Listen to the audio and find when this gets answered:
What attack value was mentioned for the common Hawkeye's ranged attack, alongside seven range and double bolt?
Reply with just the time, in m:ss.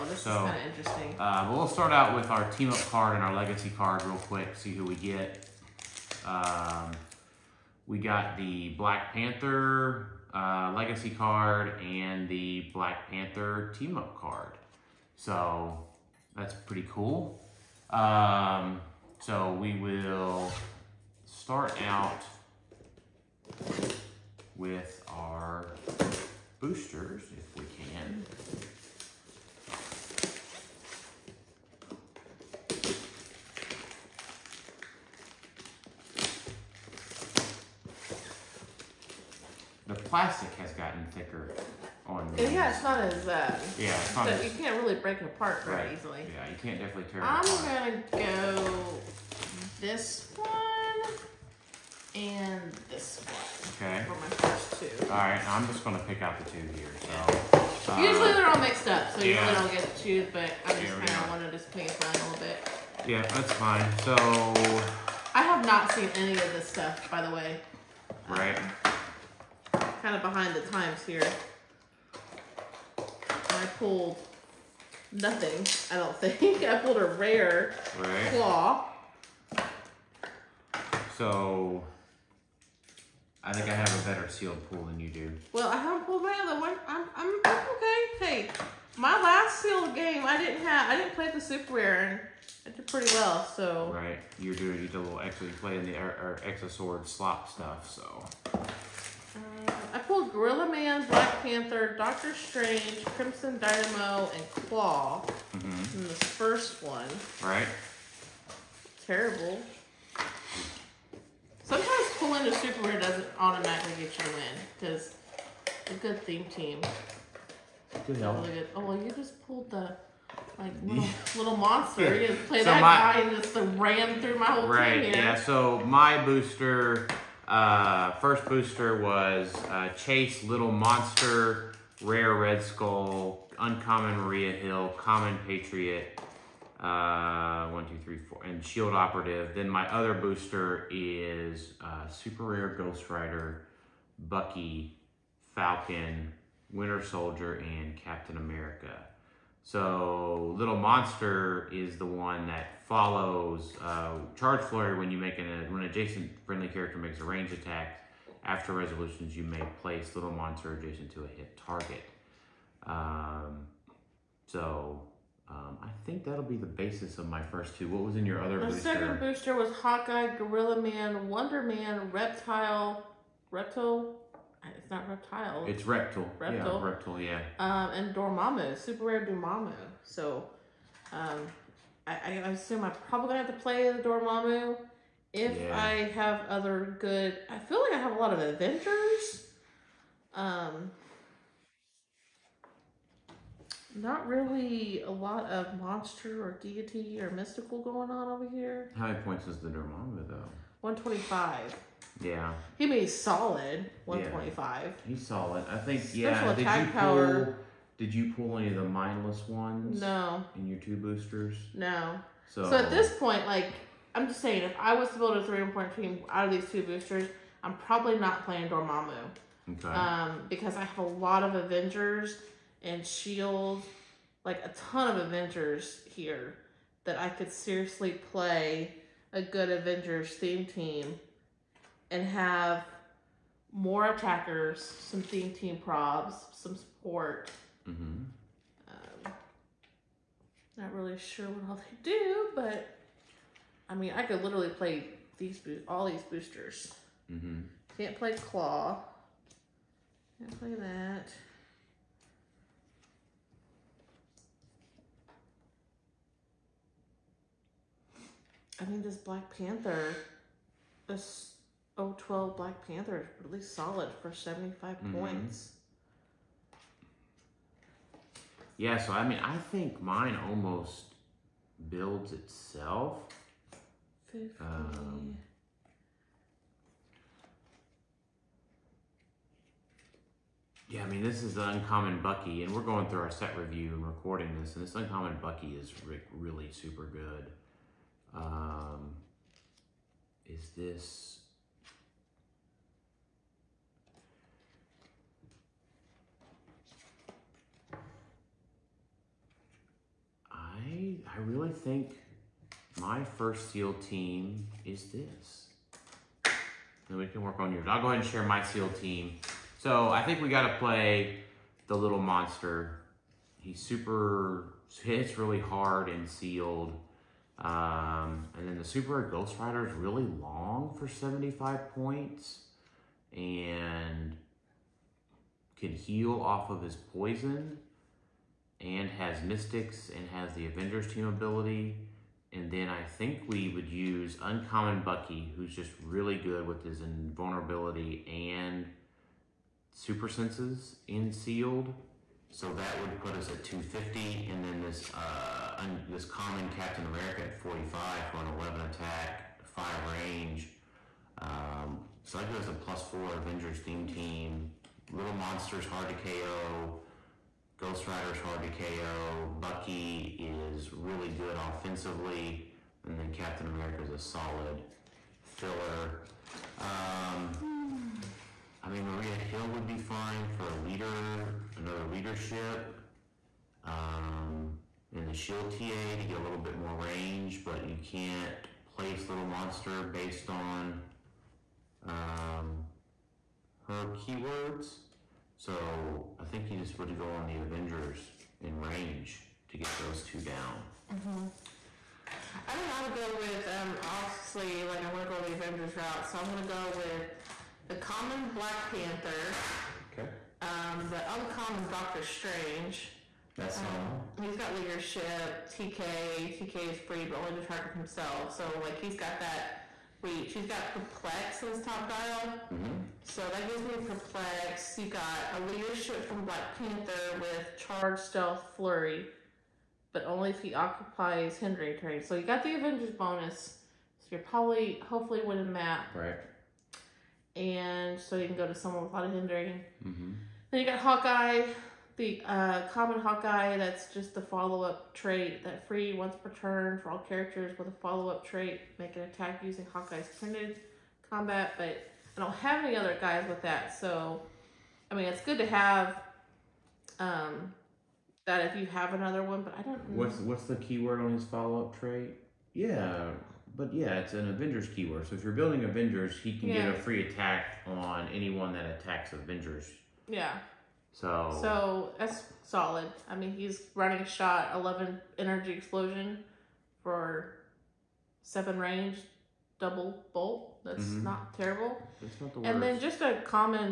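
7:44.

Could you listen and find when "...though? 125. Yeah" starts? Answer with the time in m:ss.
3:20.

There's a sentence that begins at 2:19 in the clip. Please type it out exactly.
Then my other booster is uh, Super Rare Ghost Rider, Bucky, Falcon, Winter Soldier, and Captain America.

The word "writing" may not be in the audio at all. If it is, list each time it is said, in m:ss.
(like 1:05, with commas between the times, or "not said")
not said.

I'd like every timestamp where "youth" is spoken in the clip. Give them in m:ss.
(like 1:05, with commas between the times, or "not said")
not said.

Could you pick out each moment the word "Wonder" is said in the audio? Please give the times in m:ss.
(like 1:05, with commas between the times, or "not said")
2:51.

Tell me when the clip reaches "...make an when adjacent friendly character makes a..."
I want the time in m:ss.
2:35.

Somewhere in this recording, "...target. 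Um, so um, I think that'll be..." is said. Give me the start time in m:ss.
2:41.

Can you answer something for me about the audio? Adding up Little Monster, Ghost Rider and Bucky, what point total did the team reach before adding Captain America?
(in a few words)
250.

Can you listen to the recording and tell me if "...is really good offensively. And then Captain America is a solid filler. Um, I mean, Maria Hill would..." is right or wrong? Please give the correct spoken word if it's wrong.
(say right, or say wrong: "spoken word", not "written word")
right.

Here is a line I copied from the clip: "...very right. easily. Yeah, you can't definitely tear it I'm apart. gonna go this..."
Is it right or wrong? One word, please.
right.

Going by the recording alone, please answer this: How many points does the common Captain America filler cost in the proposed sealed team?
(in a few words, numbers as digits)
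45.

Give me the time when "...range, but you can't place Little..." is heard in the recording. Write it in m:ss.
6:16.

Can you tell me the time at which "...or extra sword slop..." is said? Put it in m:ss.
1:36.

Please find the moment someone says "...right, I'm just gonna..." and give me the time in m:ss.
0:55.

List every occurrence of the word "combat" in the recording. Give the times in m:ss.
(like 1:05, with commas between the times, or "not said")
7:21.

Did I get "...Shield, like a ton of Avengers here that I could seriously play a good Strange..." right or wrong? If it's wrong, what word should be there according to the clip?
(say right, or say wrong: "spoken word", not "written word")
wrong: "Avengers", not "Strange".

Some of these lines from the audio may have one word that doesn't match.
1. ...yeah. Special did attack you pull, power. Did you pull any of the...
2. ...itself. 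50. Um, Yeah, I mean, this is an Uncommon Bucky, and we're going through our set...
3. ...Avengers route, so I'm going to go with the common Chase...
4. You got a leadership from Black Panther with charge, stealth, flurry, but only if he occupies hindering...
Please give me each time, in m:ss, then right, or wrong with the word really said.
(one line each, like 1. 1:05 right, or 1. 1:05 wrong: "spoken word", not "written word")
1. 3:26 right
2. 4:32 right
3. 6:35 wrong: "Black", not "Chase"
4. 6:54 right.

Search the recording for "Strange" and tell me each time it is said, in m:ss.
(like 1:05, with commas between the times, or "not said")
1:42, 6:42.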